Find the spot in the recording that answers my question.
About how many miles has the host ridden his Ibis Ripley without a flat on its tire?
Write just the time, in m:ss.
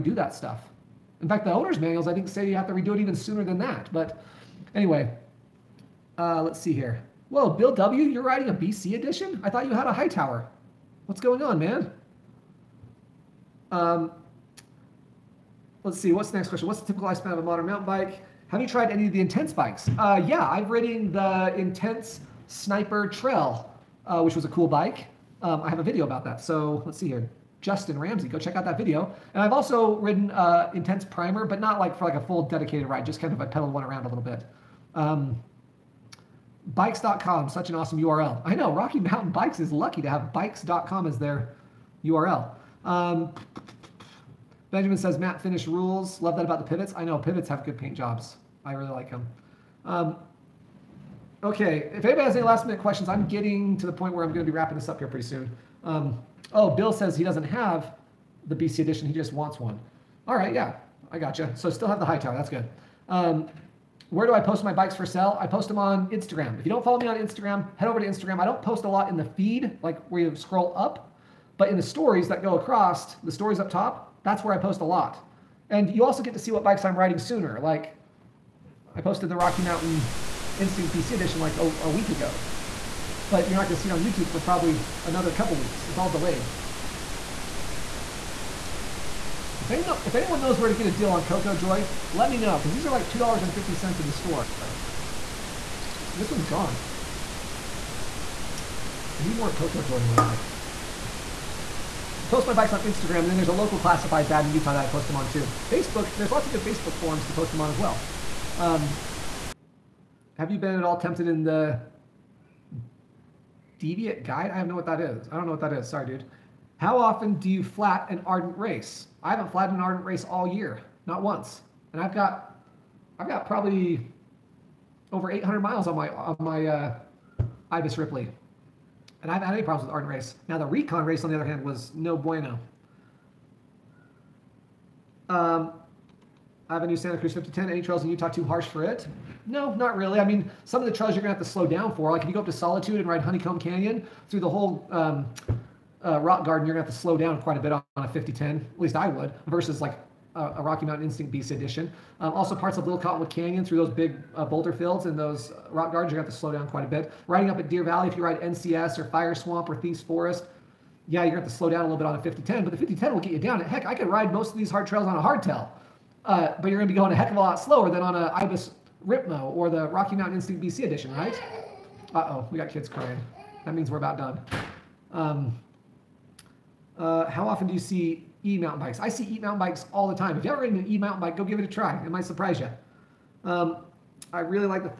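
2:05.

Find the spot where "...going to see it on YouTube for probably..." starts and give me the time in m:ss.
1:23.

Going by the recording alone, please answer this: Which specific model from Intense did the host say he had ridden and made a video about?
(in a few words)
Sniper Trail.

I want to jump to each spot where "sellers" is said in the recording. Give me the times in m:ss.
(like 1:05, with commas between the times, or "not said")
not said.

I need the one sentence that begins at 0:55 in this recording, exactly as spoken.
Um, oh, Bill says he doesn't have the BC edition, he just wants one.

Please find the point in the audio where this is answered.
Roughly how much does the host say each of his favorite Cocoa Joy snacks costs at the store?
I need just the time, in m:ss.
1:33.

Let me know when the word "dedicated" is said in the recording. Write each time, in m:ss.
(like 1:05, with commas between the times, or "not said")
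0:32.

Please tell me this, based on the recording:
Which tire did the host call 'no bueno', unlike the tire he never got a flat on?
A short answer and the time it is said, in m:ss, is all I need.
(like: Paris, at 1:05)
Rekon Race, at 2:10.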